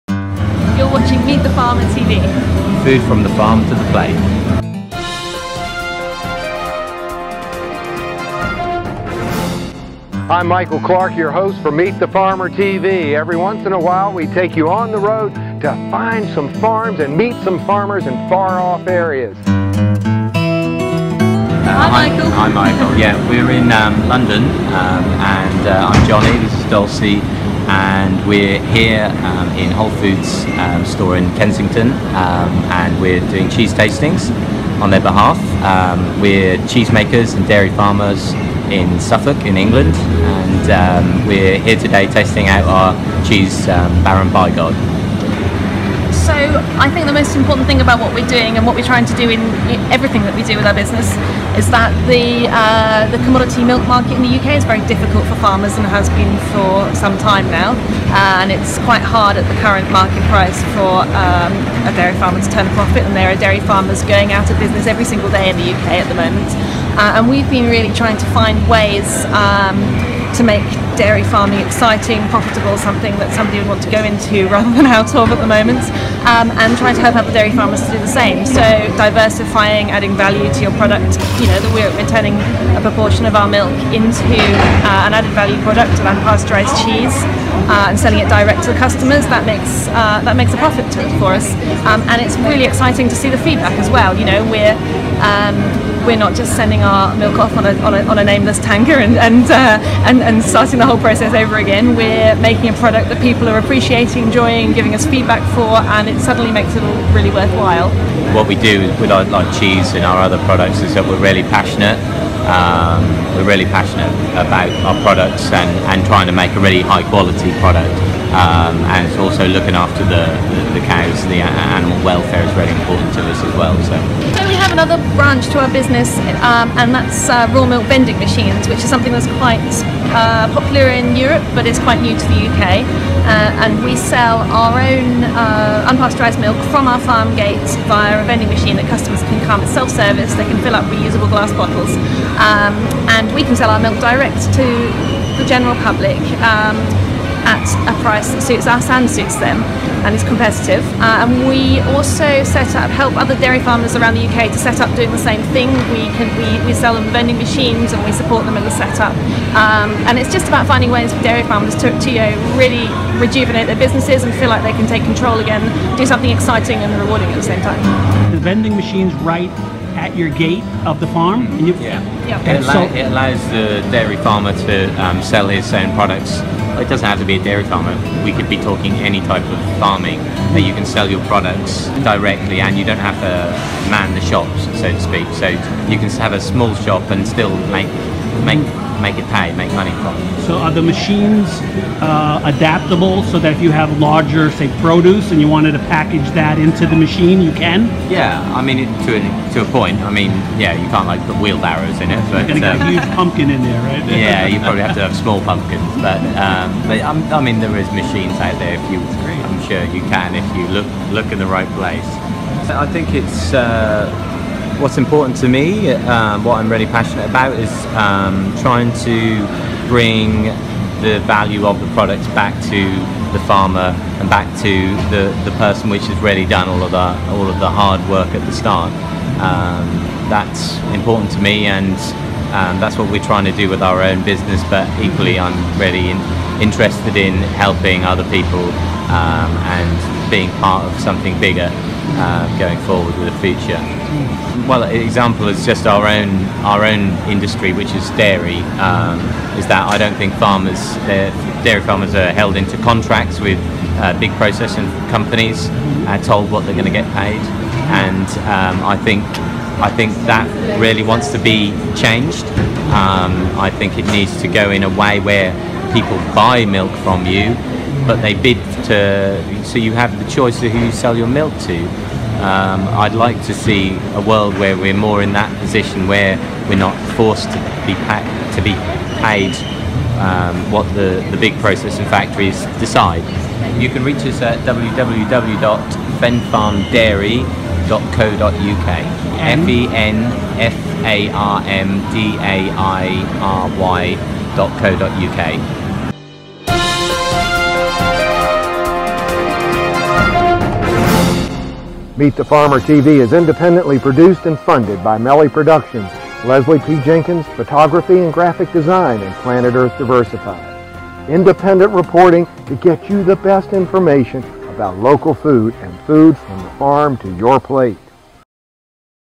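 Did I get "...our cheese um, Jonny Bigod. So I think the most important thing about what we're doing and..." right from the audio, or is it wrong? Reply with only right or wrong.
wrong.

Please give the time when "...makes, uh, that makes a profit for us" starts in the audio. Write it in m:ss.
1:29.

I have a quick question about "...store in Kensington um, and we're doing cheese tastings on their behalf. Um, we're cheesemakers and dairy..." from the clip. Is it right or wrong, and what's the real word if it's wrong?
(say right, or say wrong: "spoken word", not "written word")
right.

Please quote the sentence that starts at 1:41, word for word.
We're making a product that people are appreciating, enjoying, giving us feedback for, and it suddenly makes it all really worthwhile.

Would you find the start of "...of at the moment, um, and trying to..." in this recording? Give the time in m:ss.
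1:15.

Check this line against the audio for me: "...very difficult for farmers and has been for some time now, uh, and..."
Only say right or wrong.
right.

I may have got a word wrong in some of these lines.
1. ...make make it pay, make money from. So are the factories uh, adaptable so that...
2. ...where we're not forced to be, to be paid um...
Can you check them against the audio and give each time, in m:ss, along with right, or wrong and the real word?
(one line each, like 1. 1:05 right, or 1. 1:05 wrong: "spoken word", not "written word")
1. 3:08 wrong: "machines", not "factories"
2. 4:36 right.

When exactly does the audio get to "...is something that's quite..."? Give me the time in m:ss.
2:08.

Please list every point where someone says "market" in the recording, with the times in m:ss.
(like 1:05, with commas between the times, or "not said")
0:53, 0:59.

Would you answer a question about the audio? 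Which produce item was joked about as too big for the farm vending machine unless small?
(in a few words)
pumpkins.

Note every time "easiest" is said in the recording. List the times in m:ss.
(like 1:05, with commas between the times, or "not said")
not said.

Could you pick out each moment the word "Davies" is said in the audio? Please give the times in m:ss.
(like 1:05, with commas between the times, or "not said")
not said.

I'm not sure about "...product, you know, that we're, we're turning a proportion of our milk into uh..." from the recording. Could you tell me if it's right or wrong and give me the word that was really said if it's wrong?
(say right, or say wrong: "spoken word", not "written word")
right.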